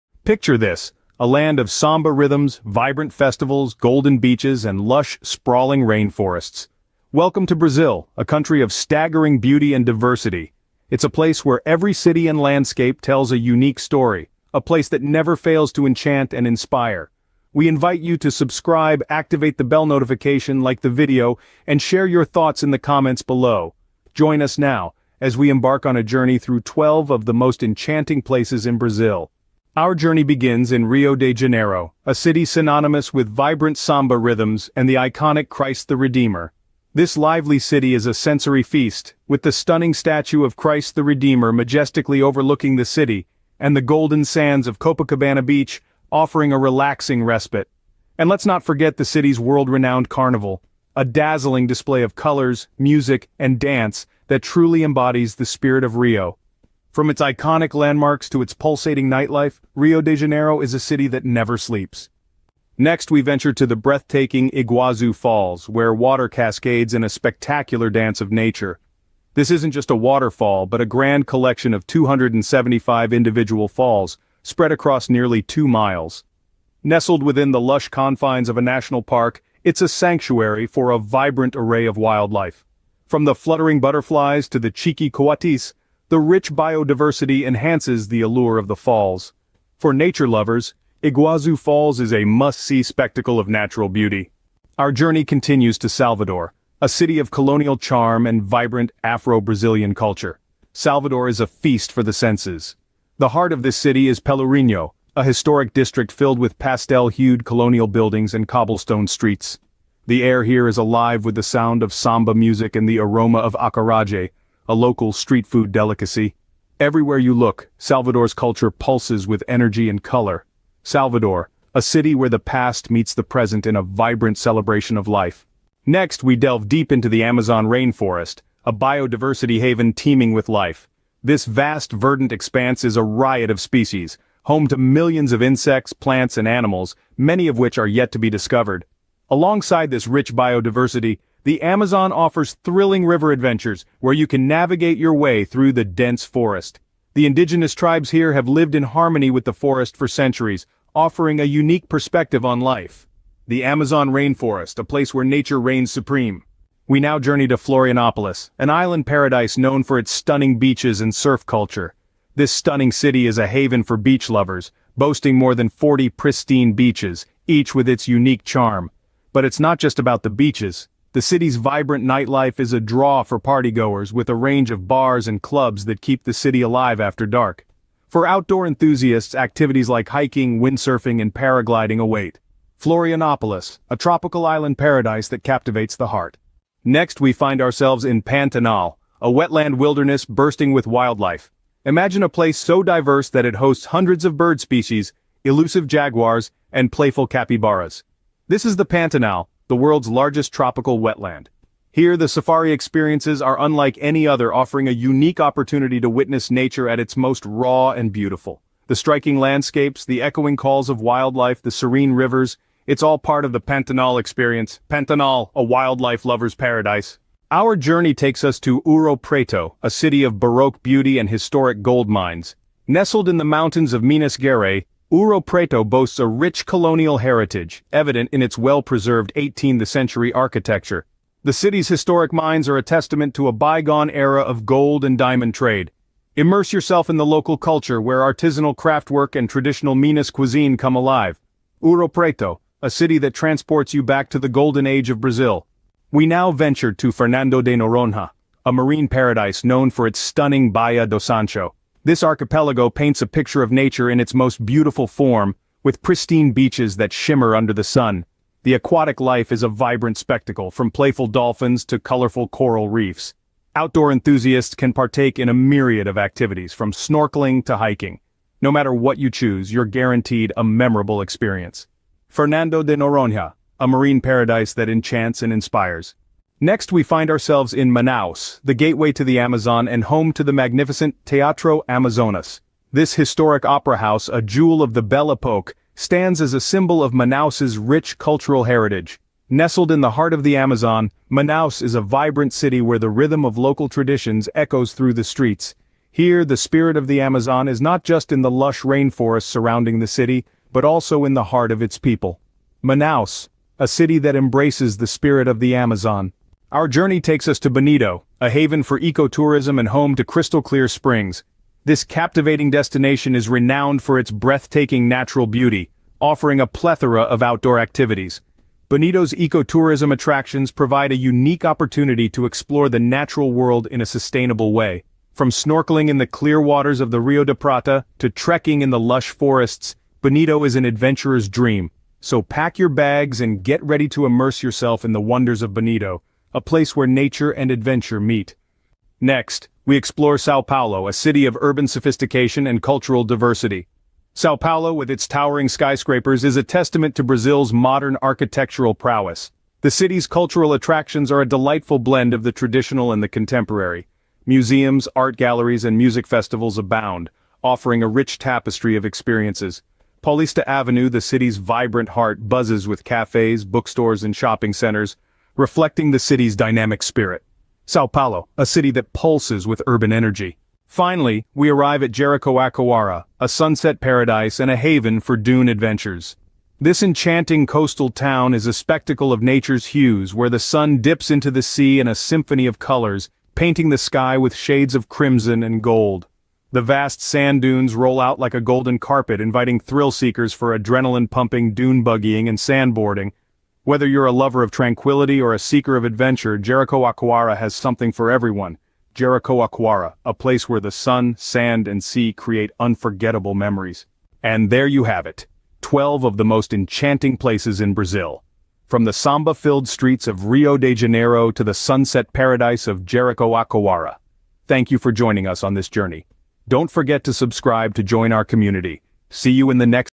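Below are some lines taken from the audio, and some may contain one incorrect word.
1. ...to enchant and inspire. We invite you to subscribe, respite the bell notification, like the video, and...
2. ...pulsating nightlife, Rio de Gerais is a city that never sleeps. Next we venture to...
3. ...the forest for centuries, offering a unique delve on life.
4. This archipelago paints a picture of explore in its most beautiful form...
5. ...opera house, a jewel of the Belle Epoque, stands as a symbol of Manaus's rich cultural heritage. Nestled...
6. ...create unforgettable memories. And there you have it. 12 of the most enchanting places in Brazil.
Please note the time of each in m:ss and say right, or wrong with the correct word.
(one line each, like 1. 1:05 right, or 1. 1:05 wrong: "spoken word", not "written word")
1. 0:15 wrong: "activate", not "respite"
2. 0:58 wrong: "Janeiro", not "Gerais"
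3. 2:29 wrong: "perspective", not "delve"
4. 4:12 wrong: "nature", not "explore"
5. 4:43 right
6. 6:42 right.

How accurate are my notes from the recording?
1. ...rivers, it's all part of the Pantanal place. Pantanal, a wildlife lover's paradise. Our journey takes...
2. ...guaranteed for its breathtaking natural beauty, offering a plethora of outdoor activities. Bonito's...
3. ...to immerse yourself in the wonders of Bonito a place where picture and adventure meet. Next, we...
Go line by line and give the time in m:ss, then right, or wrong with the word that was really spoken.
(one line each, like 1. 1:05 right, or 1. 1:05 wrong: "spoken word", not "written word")
1. 3:32 wrong: "experience", not "place"
2. 5:13 wrong: "renowned", not "guaranteed"
3. 5:34 wrong: "nature", not "picture".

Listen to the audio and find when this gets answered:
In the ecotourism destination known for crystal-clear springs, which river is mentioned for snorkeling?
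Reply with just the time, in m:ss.
5:27.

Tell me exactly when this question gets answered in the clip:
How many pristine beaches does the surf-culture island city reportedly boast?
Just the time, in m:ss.
2:45.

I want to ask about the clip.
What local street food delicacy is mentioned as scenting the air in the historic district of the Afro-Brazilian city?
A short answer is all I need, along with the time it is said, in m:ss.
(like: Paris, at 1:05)
acaraje, at 1:53.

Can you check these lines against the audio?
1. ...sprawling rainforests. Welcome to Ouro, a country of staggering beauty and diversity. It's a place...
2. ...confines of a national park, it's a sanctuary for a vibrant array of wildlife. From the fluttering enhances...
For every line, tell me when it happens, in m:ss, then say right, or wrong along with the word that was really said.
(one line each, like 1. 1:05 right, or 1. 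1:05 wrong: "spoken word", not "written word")
1. 0:05 wrong: "Brazil", not "Ouro"
2. 1:17 wrong: "butterflies", not "enhances".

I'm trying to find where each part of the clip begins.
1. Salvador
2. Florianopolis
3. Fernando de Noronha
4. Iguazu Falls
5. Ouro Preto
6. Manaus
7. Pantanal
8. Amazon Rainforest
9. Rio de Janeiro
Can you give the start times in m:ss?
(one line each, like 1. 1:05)
1. 1:34
2. 2:36
3. 4:05
4. 1:02
5. 3:37
6. 4:36
7. 3:06
8. 2:05
9. 0:29.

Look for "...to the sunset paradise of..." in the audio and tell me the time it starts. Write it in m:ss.
6:51.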